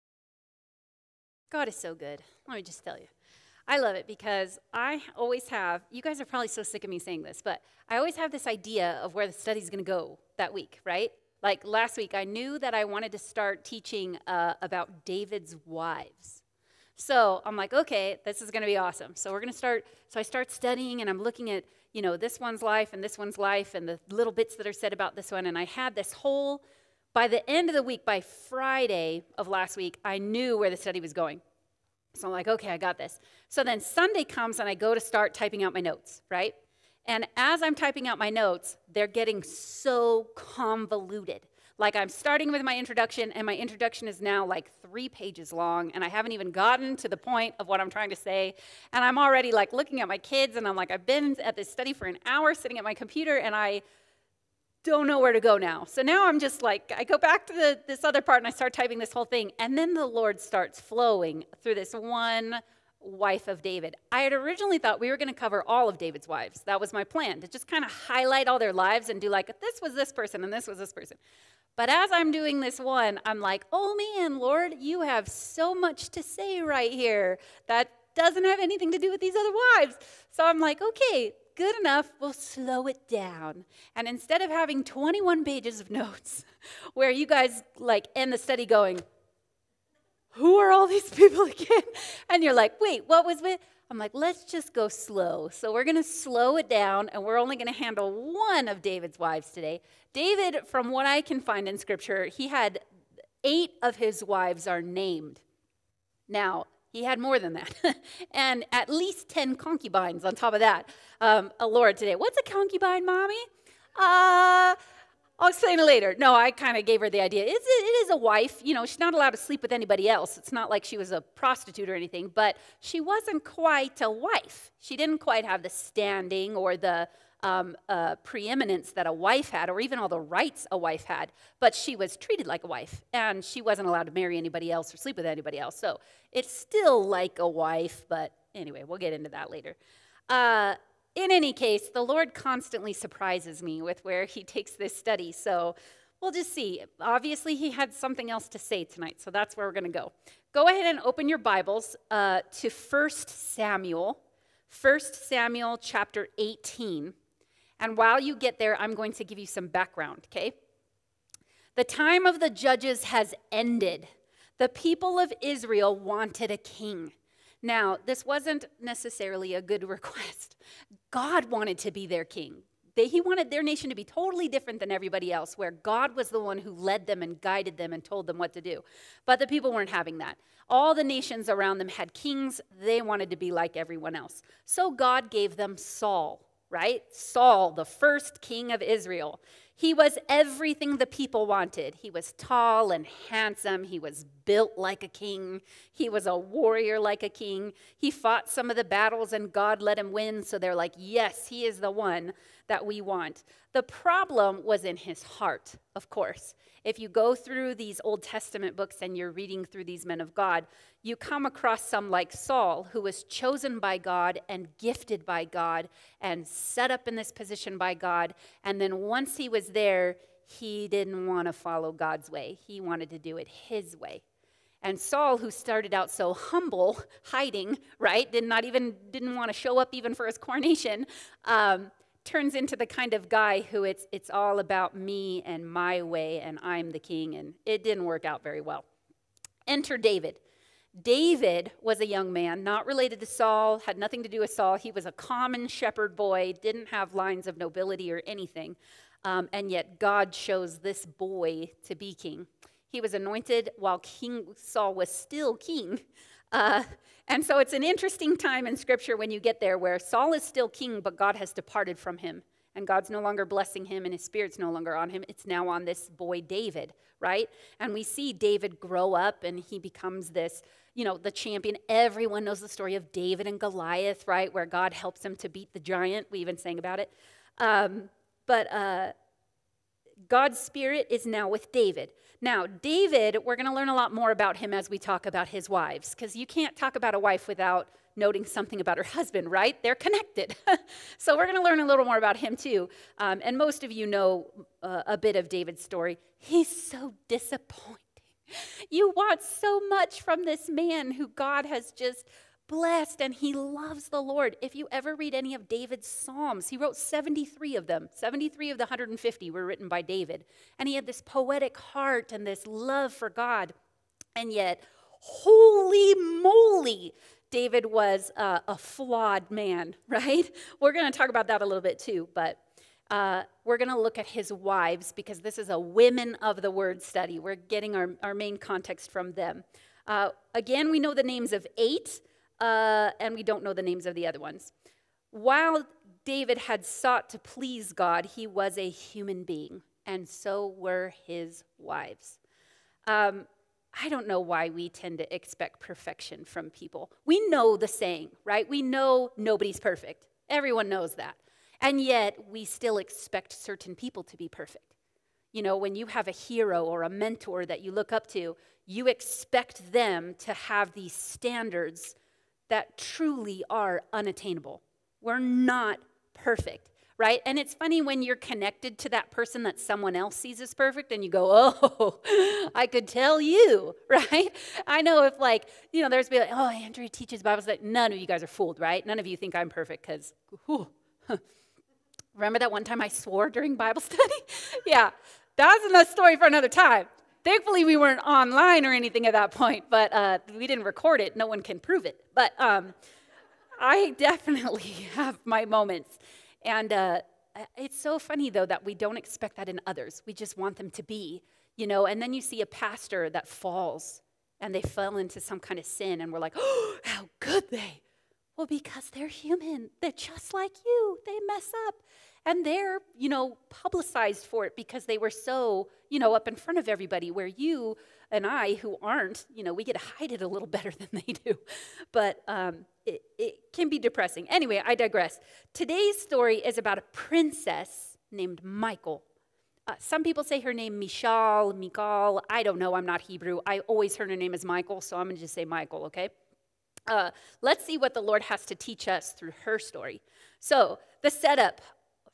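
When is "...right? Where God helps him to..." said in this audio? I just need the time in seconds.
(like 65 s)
274 s.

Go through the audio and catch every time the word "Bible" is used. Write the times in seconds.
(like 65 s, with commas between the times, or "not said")
151 s, 377 s, 383 s.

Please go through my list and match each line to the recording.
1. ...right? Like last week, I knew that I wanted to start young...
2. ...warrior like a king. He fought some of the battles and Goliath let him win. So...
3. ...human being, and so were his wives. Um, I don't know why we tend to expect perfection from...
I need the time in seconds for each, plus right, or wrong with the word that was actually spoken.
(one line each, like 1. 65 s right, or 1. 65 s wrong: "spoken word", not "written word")
1. 10 s wrong: "teaching", not "young"
2. 196 s wrong: "God", not "Goliath"
3. 338 s right.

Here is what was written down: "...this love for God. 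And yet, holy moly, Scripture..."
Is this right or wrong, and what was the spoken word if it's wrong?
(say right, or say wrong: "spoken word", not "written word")
wrong: "David", not "Scripture".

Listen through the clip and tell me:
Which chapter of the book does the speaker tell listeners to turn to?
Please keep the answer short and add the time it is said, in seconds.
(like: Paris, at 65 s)
18, at 155 s.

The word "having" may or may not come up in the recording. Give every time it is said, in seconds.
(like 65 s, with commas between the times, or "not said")
84 s, 179 s.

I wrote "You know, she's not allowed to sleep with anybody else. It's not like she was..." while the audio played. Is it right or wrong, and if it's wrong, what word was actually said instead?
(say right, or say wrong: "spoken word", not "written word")
right.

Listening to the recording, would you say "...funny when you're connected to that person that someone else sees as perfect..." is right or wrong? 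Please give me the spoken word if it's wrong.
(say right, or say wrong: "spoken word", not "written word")
right.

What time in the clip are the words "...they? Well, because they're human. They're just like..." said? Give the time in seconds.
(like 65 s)
407 s.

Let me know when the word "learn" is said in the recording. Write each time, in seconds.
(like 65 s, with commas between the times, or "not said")
283 s, 291 s.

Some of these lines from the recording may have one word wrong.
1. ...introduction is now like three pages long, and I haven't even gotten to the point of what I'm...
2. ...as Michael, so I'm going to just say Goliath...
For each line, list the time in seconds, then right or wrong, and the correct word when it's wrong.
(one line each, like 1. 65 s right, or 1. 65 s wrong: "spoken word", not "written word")
1. 43 s right
2. 434 s wrong: "Michael", not "Goliath".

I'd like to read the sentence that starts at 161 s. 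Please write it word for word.
The time of the judges has ended.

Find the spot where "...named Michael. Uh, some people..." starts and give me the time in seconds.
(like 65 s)
428 s.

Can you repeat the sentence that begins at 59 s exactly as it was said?
And then the Lord starts flowing through this one wife of David.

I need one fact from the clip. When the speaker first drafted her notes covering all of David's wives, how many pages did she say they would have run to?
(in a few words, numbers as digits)
21.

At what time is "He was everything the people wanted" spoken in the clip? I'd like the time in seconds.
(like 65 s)
189 s.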